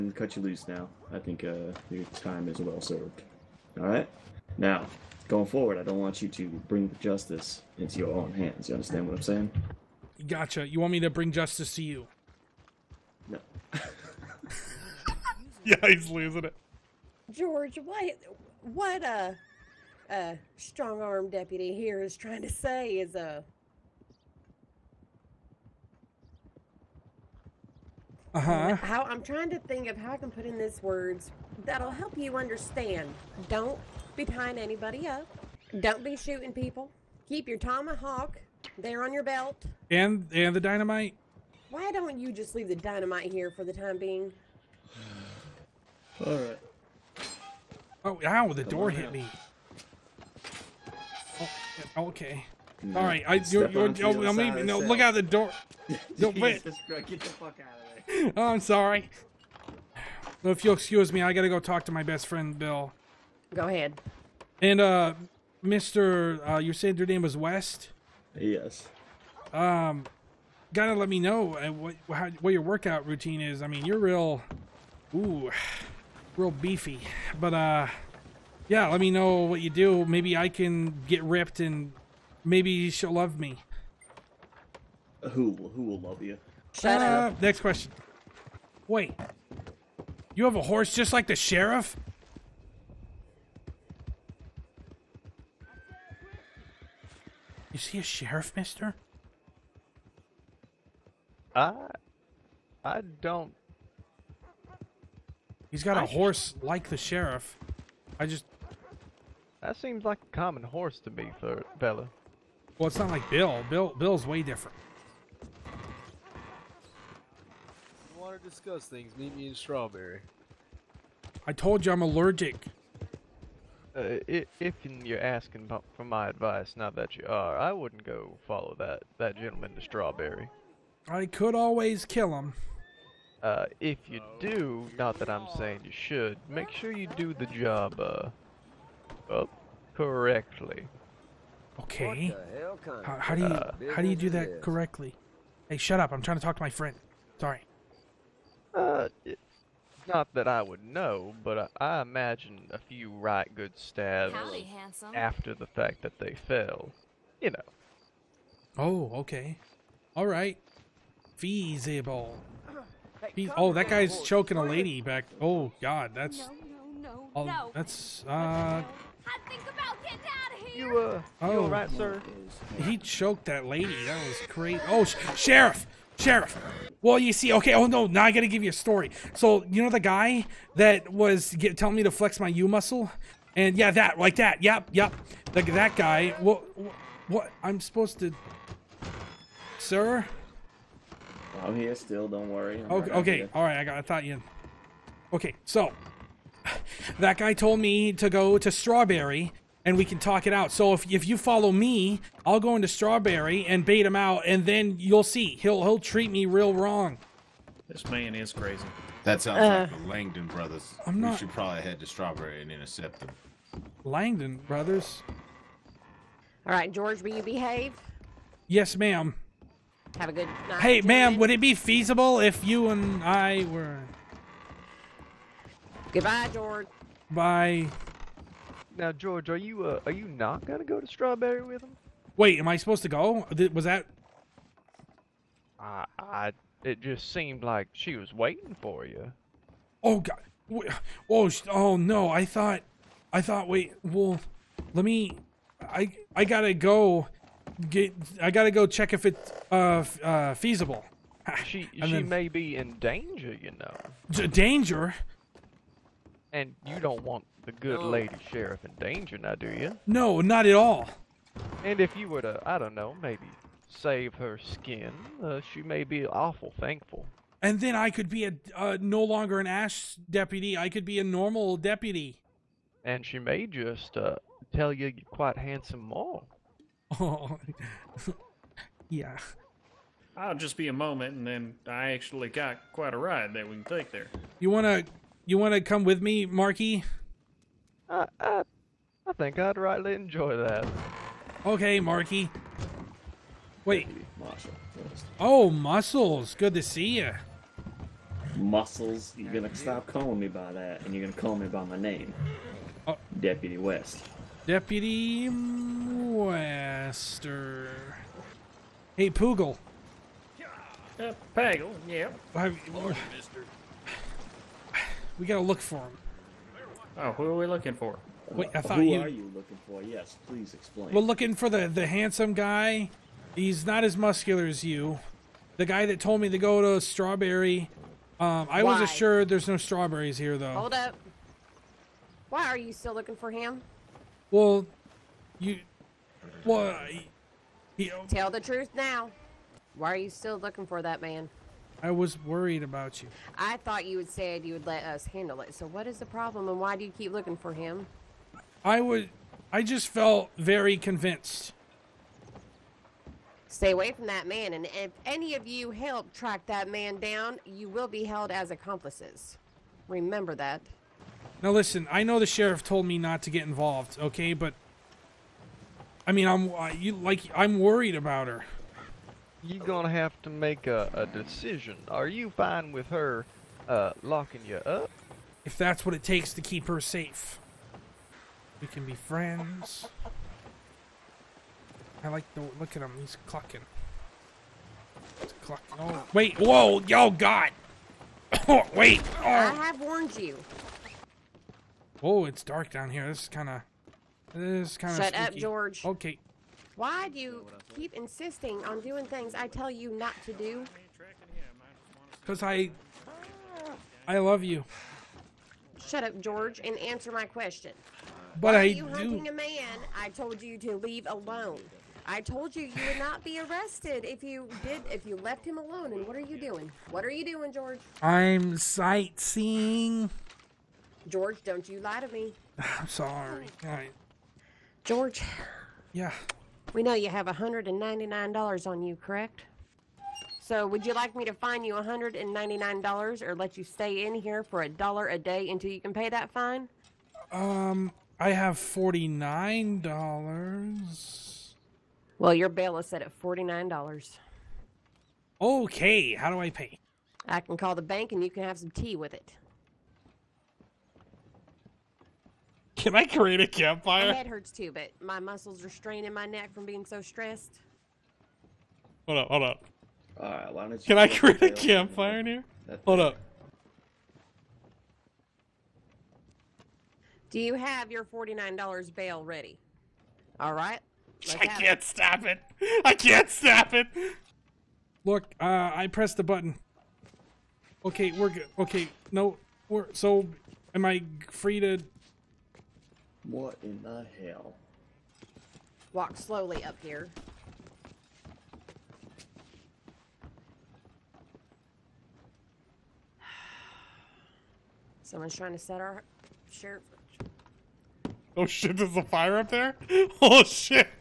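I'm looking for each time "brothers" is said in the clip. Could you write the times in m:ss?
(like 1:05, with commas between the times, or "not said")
3:30, 3:34.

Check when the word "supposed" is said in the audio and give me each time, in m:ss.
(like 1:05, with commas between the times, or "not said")
3:07, 3:52.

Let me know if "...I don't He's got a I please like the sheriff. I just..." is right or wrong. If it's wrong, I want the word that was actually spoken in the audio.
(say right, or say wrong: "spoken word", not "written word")
wrong: "horse", not "please".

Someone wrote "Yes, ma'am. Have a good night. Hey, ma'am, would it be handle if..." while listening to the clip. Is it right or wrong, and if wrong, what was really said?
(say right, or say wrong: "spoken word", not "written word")
wrong: "feasible", not "handle".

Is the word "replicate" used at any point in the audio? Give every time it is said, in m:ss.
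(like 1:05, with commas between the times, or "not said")
not said.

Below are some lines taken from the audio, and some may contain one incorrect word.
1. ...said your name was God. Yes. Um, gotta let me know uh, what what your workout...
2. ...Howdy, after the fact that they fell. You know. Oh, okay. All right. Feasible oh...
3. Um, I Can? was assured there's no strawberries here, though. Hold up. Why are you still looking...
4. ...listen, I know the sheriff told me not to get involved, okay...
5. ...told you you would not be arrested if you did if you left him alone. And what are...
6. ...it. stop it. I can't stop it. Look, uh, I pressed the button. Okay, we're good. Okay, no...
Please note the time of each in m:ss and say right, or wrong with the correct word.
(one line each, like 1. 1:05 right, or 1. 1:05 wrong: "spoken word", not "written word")
1. 1:06 wrong: "West", not "God"
2. 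2:34 right
3. 5:28 wrong: "Why", not "Can"
4. 6:01 right
5. 6:52 right
6. 7:52 right.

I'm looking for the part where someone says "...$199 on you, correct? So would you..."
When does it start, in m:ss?
7:07.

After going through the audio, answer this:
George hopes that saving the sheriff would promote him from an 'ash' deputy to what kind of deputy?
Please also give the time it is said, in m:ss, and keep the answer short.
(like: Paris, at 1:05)
A normal deputy, at 4:31.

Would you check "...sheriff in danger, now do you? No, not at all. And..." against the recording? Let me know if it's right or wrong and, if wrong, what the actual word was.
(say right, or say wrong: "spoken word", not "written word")
right.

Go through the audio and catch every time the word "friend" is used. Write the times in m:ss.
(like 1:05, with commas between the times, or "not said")
1:02, 2:26, 6:19.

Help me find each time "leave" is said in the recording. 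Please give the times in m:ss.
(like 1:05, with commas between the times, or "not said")
0:42, 6:50.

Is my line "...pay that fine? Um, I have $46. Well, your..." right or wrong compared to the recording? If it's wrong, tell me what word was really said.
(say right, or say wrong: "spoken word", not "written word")
wrong: "49", not "46".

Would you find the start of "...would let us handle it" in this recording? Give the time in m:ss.
5:44.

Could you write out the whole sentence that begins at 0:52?
No, All right, I you're, you're, you're, oh, I mean, no, look out the door.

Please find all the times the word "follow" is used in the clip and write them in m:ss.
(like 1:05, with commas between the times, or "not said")
2:08, 3:21.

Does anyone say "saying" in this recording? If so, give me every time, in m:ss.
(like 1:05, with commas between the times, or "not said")
0:09, 2:15.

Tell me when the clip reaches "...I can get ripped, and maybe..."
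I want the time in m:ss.
1:20.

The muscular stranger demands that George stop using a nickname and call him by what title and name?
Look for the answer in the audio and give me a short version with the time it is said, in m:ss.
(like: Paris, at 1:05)
Deputy West, at 5:03.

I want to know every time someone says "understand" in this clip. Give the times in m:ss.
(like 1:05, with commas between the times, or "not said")
0:08, 0:32.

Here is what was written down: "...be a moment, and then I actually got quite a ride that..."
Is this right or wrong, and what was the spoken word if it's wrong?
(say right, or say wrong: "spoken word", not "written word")
right.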